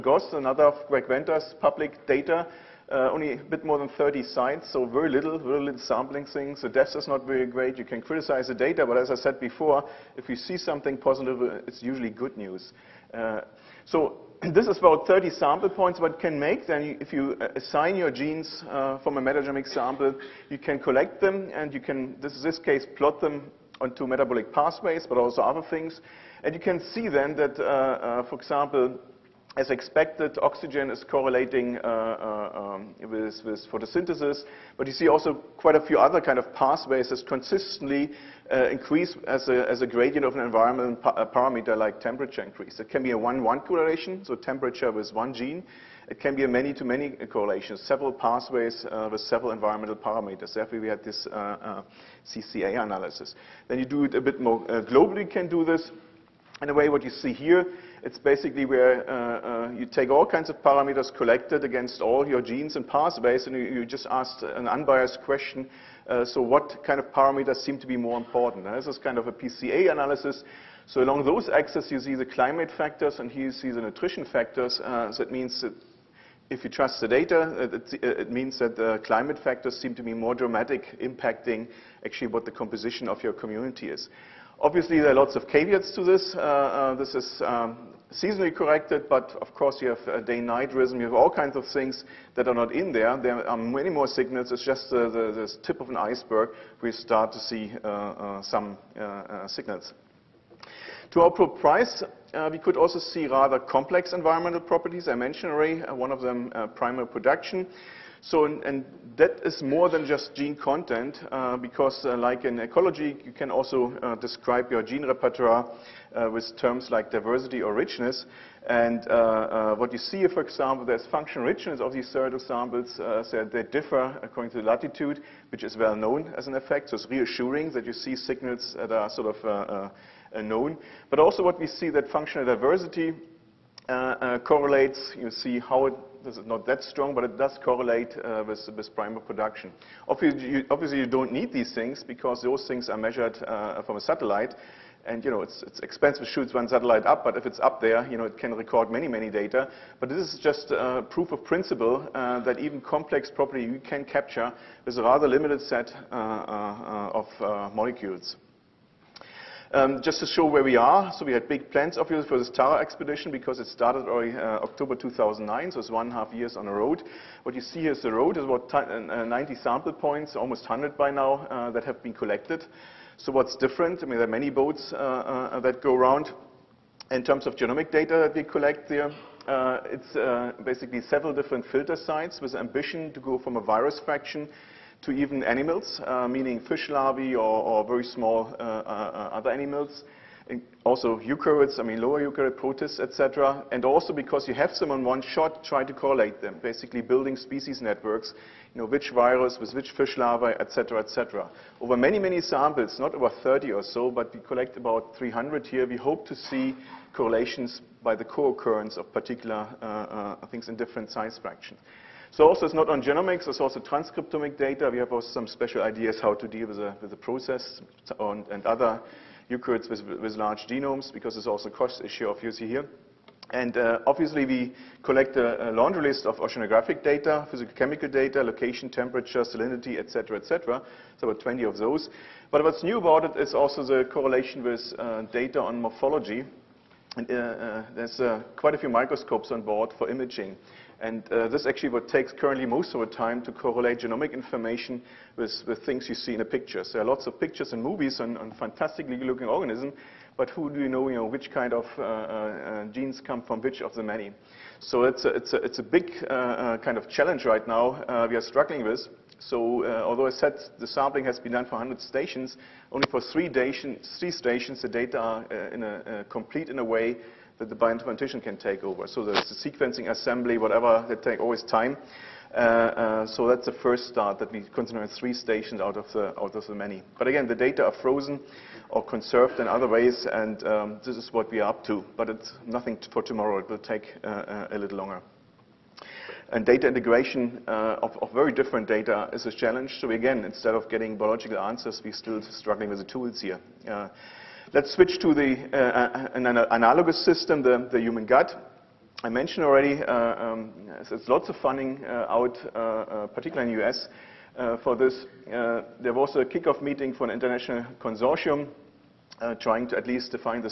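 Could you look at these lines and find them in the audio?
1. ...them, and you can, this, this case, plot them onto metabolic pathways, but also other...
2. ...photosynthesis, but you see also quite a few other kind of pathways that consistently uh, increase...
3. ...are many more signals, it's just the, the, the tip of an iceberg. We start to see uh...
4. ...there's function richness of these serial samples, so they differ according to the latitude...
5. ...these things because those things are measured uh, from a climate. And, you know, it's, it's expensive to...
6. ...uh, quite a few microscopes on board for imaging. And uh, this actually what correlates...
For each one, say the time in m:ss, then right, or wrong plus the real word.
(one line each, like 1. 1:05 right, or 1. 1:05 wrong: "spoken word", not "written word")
1. 0:21 right
2. 0:33 right
3. 1:33 right
4. 2:00 right
5. 2:21 wrong: "satellite", not "climate"
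6. 3:58 wrong: "takes", not "correlates".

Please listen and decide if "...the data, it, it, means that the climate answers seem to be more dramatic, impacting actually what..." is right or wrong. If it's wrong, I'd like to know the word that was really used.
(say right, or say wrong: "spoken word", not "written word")
wrong: "factors", not "answers".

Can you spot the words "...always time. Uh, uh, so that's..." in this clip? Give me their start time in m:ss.
4:31.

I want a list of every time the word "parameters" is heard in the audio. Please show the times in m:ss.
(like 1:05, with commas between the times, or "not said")
0:41, 0:49, 1:00, 1:07.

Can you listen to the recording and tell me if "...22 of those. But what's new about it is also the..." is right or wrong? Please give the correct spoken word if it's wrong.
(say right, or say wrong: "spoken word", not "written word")
wrong: "20", not "22".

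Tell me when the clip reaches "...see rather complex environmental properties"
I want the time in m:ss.
1:42.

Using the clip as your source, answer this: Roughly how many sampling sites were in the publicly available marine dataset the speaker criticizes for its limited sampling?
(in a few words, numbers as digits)
30.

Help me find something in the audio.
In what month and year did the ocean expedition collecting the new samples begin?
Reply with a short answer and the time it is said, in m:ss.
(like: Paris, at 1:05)
October 2009, at 2:44.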